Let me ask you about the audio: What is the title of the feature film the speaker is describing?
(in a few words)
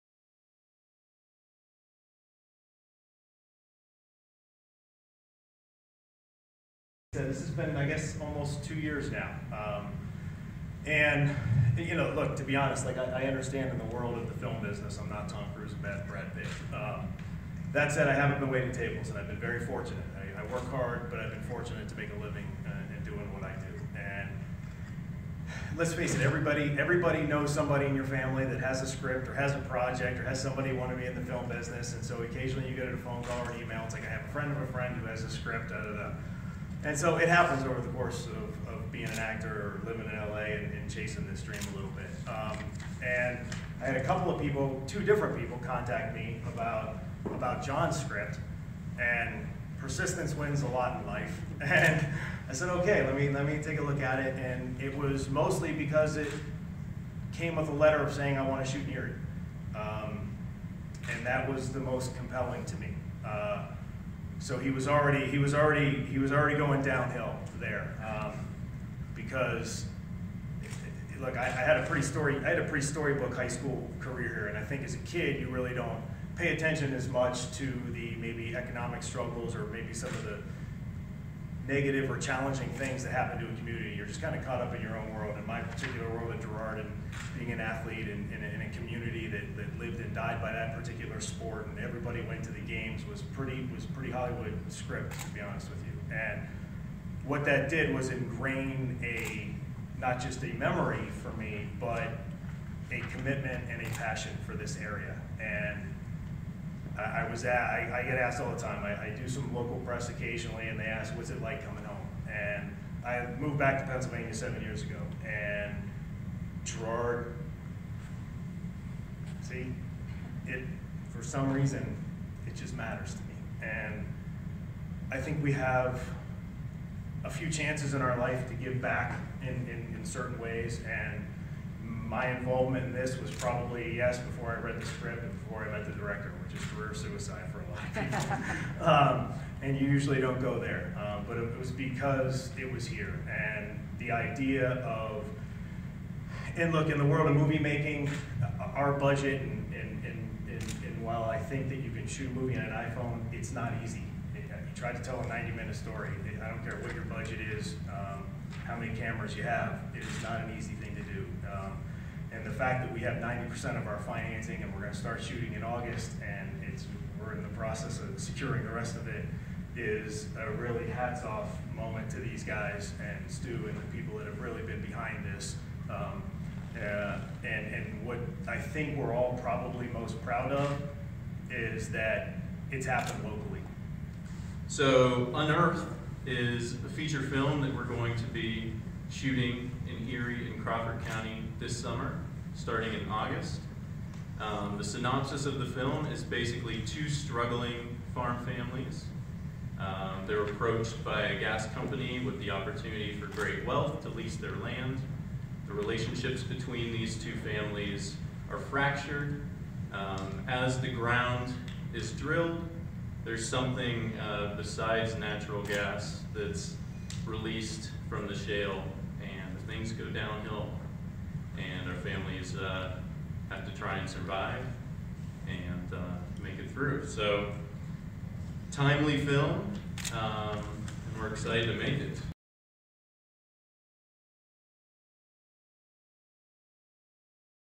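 Unearth.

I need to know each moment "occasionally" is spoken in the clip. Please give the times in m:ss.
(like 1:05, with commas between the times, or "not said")
0:32, 1:50.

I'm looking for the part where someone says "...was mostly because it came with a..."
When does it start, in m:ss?
0:54.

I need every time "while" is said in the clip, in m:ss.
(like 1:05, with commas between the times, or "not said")
2:31.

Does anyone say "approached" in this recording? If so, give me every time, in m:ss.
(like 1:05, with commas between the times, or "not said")
3:20.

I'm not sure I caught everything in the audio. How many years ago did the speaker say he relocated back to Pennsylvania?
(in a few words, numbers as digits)
7.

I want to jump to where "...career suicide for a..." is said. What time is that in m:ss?
2:16.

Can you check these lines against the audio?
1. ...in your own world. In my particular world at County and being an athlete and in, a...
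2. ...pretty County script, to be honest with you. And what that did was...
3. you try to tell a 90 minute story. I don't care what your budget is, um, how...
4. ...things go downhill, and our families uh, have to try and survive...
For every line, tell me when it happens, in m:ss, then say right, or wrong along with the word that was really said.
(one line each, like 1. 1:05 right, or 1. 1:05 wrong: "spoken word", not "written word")
1. 1:24 wrong: "Girard", not "County"
2. 1:33 wrong: "Hollywood", not "County"
3. 2:34 right
4. 3:39 right.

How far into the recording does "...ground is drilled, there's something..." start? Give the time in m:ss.
3:30.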